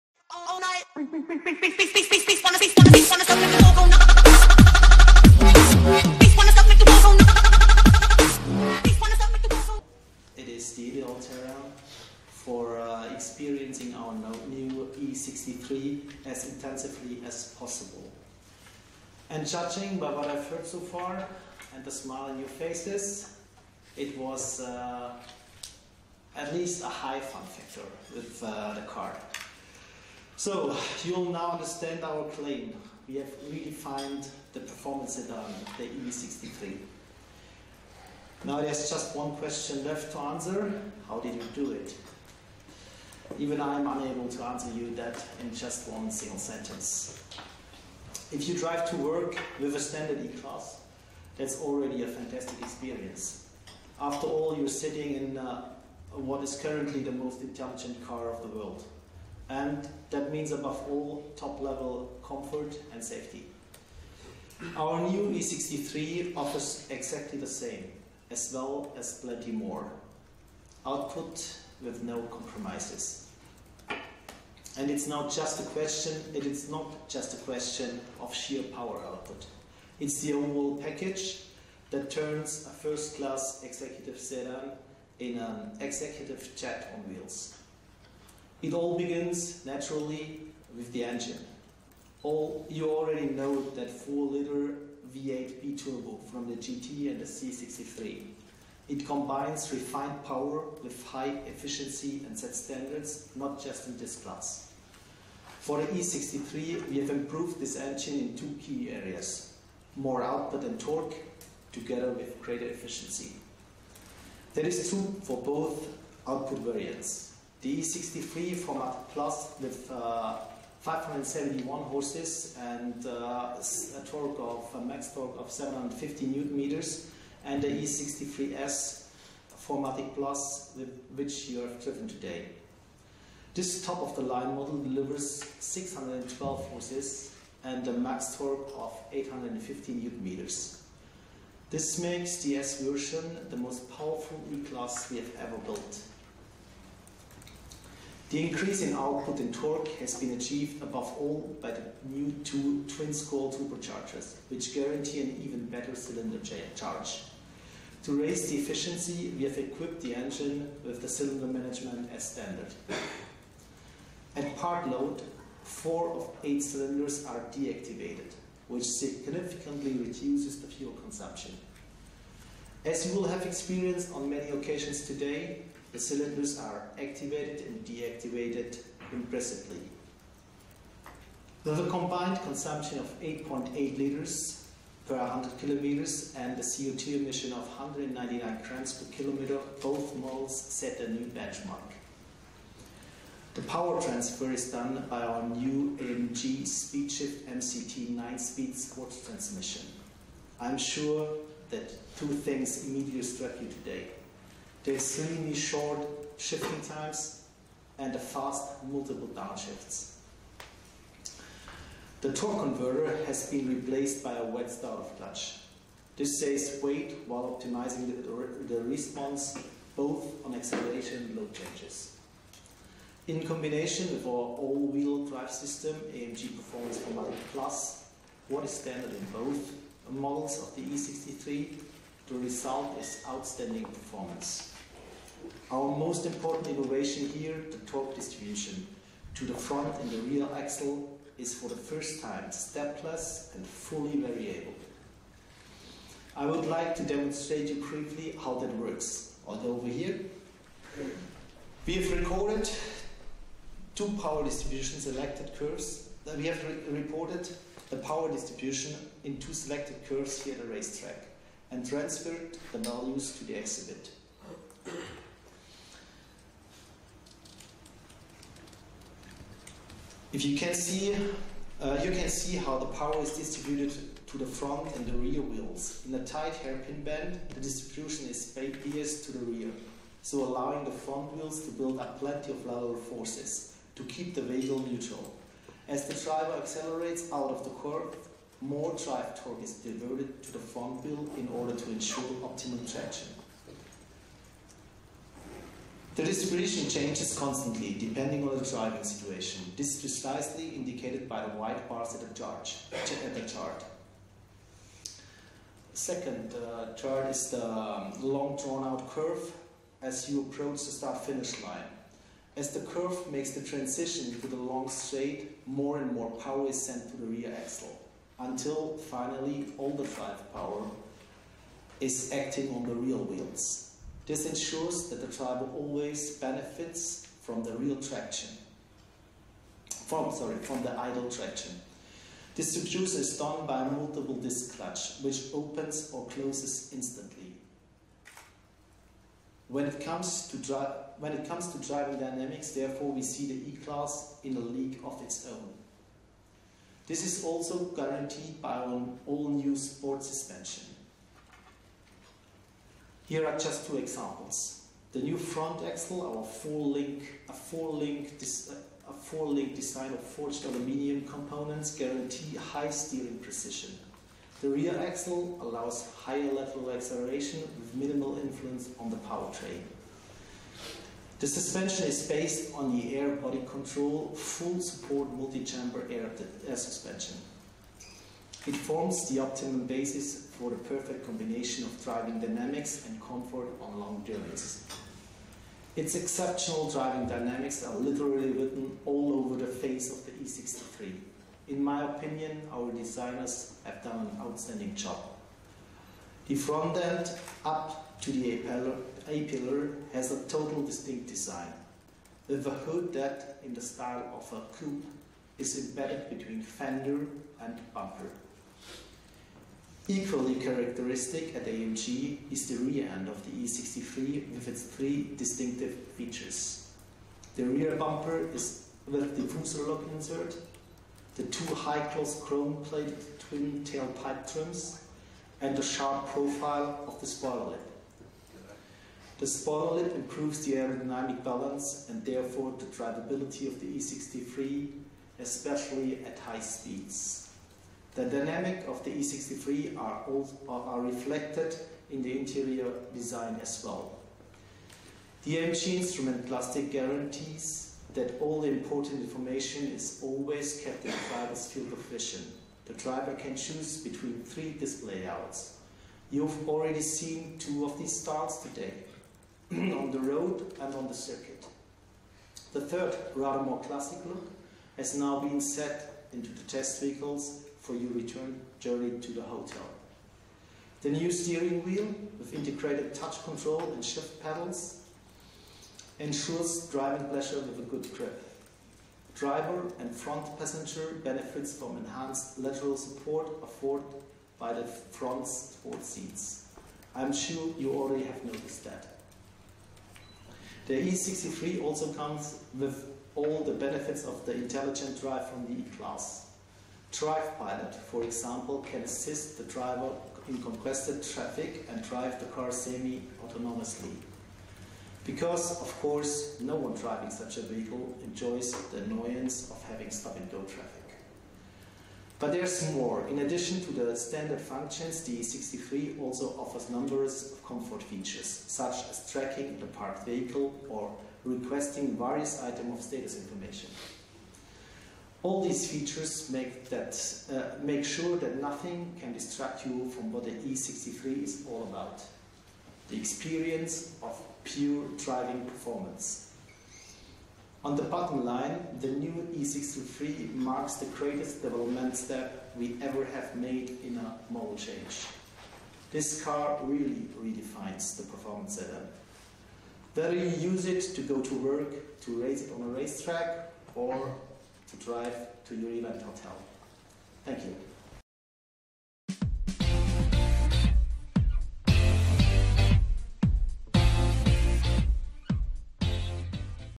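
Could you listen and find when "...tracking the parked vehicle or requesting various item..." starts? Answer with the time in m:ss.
8:39.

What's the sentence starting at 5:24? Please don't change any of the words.
This ensures that the driver always benefits from the real traction.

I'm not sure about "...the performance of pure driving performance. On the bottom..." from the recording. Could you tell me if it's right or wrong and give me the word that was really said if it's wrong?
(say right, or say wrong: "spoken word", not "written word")
wrong: "experience", not "performance".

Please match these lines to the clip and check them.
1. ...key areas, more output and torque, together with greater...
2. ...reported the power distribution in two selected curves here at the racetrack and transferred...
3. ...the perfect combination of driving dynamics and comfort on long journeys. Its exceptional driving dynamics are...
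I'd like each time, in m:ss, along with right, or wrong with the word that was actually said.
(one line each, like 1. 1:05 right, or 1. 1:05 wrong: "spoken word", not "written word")
1. 1:48 right
2. 4:17 right
3. 6:20 right.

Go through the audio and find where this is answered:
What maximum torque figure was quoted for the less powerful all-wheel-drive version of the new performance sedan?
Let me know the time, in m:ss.
2:05.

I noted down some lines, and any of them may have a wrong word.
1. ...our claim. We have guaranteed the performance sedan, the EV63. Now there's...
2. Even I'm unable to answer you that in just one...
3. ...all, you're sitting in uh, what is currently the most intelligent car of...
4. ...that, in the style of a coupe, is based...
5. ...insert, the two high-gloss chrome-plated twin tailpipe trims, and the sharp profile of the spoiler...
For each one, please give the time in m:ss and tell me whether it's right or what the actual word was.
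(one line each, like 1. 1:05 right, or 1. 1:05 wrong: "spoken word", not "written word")
1. 0:32 wrong: "redefined", not "guaranteed"
2. 0:43 right
3. 0:54 right
4. 6:43 wrong: "embedded", not "based"
5. 7:00 right.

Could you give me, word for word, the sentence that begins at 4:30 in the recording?
If you can see, uh, you can see how the power is distributed to the front and the rear wheels.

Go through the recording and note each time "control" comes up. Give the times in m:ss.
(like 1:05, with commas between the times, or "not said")
6:13, 7:53.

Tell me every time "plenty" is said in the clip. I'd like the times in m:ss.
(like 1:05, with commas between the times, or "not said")
1:09, 4:42.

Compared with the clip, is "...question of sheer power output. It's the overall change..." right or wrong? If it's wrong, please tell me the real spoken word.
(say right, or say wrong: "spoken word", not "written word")
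wrong: "package", not "change".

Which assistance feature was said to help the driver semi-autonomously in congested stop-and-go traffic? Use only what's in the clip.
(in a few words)
Drive Pilot.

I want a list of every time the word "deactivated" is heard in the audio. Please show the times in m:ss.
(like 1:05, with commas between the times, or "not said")
2:47, 2:57.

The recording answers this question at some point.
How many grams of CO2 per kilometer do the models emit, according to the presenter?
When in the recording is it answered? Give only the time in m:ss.
3:07.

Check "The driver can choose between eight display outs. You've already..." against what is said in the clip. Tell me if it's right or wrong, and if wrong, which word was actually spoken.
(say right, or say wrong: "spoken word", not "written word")
wrong: "three", not "eight".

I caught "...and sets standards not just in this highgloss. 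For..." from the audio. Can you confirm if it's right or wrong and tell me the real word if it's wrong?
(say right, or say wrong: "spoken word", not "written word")
wrong: "class", not "highgloss".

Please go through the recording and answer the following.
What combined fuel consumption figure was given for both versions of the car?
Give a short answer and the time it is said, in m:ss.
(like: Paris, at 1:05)
8.8 liters per 100 km, at 3:03.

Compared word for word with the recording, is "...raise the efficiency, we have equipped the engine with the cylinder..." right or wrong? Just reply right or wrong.
right.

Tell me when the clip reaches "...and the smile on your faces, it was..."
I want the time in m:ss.
0:21.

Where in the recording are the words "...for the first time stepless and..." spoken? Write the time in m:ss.
4:01.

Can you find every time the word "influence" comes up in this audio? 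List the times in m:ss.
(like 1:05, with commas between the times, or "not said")
6:08.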